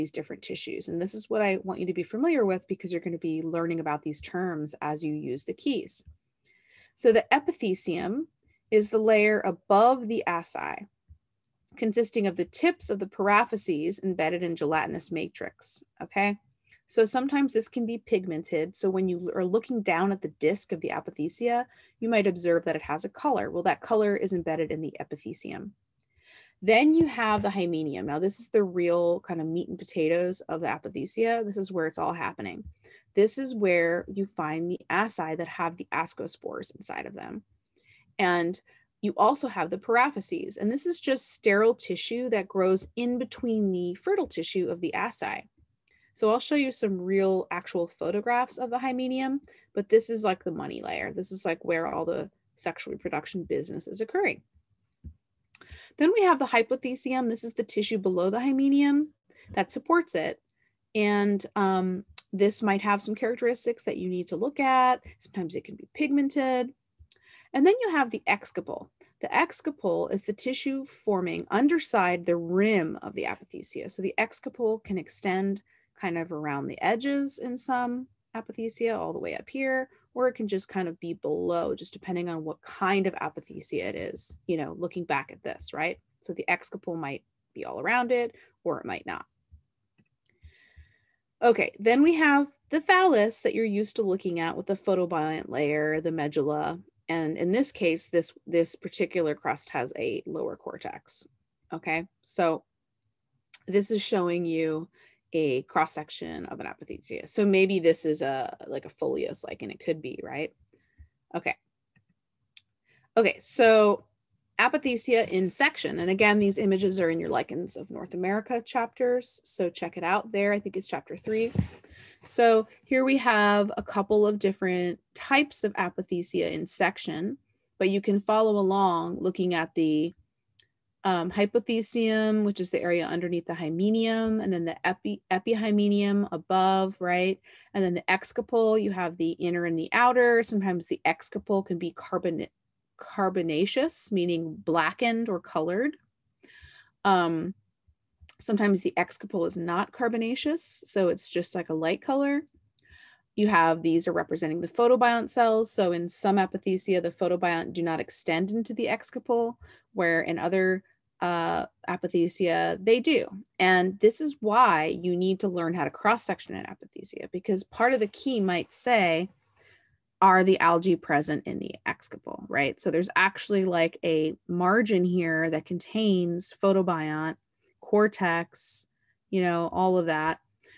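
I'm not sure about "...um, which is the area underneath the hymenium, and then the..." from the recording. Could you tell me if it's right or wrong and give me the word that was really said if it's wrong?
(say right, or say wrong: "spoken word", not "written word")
right.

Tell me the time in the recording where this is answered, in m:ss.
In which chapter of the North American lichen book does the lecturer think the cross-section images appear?
2:00.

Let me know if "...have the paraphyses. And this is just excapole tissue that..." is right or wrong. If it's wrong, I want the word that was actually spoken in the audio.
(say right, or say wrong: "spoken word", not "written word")
wrong: "sterile", not "excapole".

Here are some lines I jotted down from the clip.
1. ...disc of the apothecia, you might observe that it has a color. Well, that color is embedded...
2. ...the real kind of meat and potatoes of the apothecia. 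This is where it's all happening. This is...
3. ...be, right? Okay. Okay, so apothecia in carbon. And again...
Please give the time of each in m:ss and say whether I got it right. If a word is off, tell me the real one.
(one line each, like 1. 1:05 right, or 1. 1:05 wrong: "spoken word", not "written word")
1. 0:20 right
2. 0:28 right
3. 1:50 wrong: "section", not "carbon".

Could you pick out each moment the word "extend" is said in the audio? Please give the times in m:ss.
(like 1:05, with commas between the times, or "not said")
1:14, 2:37.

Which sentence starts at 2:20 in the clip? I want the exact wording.
Sometimes the excapole can be carbon carbonaceous, meaning blackened or colored.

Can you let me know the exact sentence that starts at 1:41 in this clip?
Okay, so this is showing you a cross section of an apothecia.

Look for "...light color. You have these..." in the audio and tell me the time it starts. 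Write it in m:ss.
2:31.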